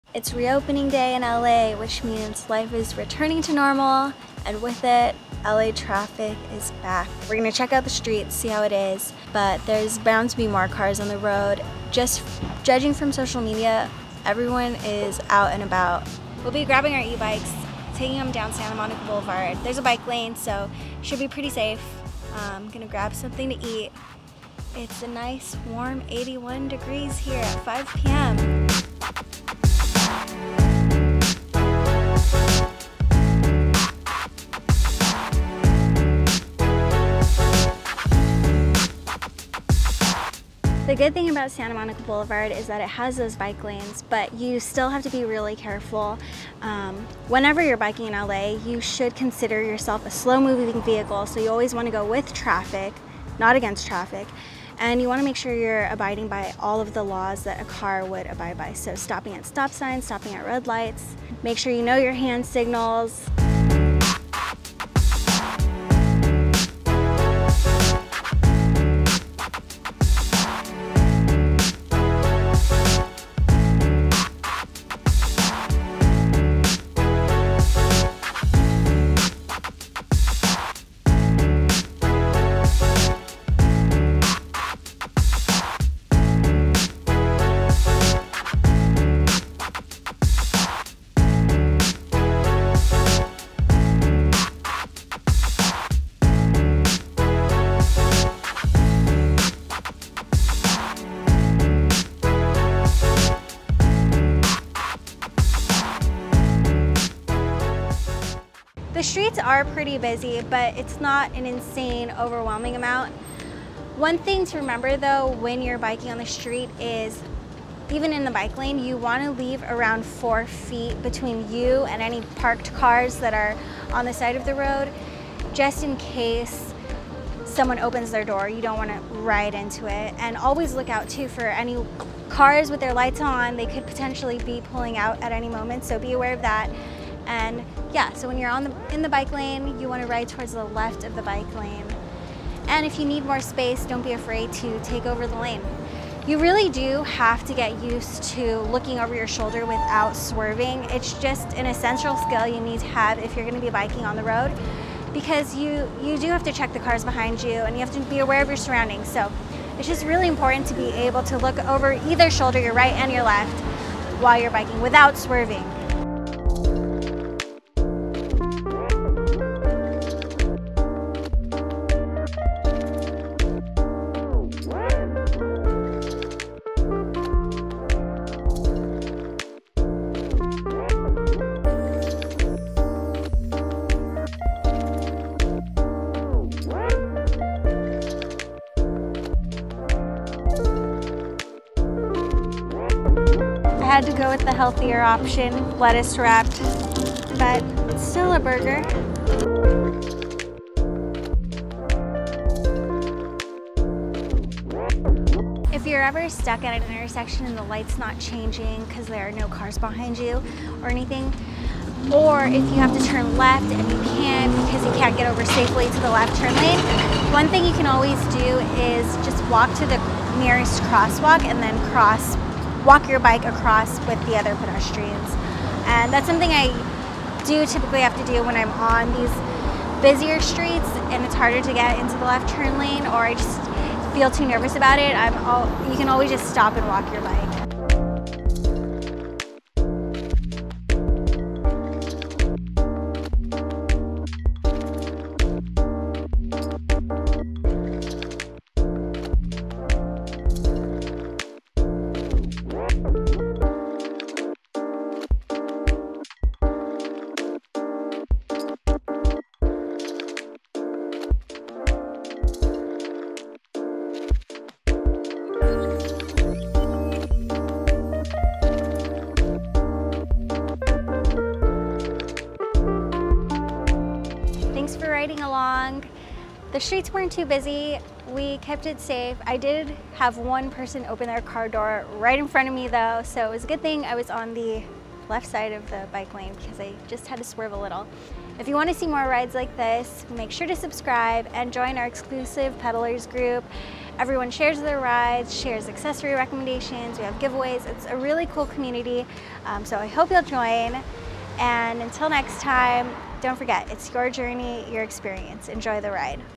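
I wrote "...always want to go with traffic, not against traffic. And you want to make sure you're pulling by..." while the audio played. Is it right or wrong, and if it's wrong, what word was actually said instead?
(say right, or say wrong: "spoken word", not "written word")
wrong: "abiding", not "pulling".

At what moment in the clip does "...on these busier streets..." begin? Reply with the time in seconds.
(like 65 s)
228 s.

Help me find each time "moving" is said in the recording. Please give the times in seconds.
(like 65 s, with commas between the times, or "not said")
50 s.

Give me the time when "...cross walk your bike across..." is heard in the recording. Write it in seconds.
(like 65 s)
221 s.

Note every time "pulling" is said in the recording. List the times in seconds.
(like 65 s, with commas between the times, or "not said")
134 s.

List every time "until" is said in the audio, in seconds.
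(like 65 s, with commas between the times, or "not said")
302 s.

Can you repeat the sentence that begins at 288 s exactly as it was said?
If you want to see more rides like this, make sure to subscribe and join our exclusive pedalers group.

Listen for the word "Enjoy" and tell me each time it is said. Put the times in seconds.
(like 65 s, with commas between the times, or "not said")
305 s.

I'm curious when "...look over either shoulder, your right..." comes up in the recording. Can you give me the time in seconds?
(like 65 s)
161 s.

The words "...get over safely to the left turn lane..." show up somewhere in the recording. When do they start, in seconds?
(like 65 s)
215 s.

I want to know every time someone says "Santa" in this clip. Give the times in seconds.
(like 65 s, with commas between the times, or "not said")
18 s, 41 s.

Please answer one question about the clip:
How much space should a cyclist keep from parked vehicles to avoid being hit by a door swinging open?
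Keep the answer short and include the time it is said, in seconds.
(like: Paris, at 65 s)
4 feet, at 120 s.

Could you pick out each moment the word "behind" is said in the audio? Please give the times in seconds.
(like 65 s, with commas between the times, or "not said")
157 s, 209 s.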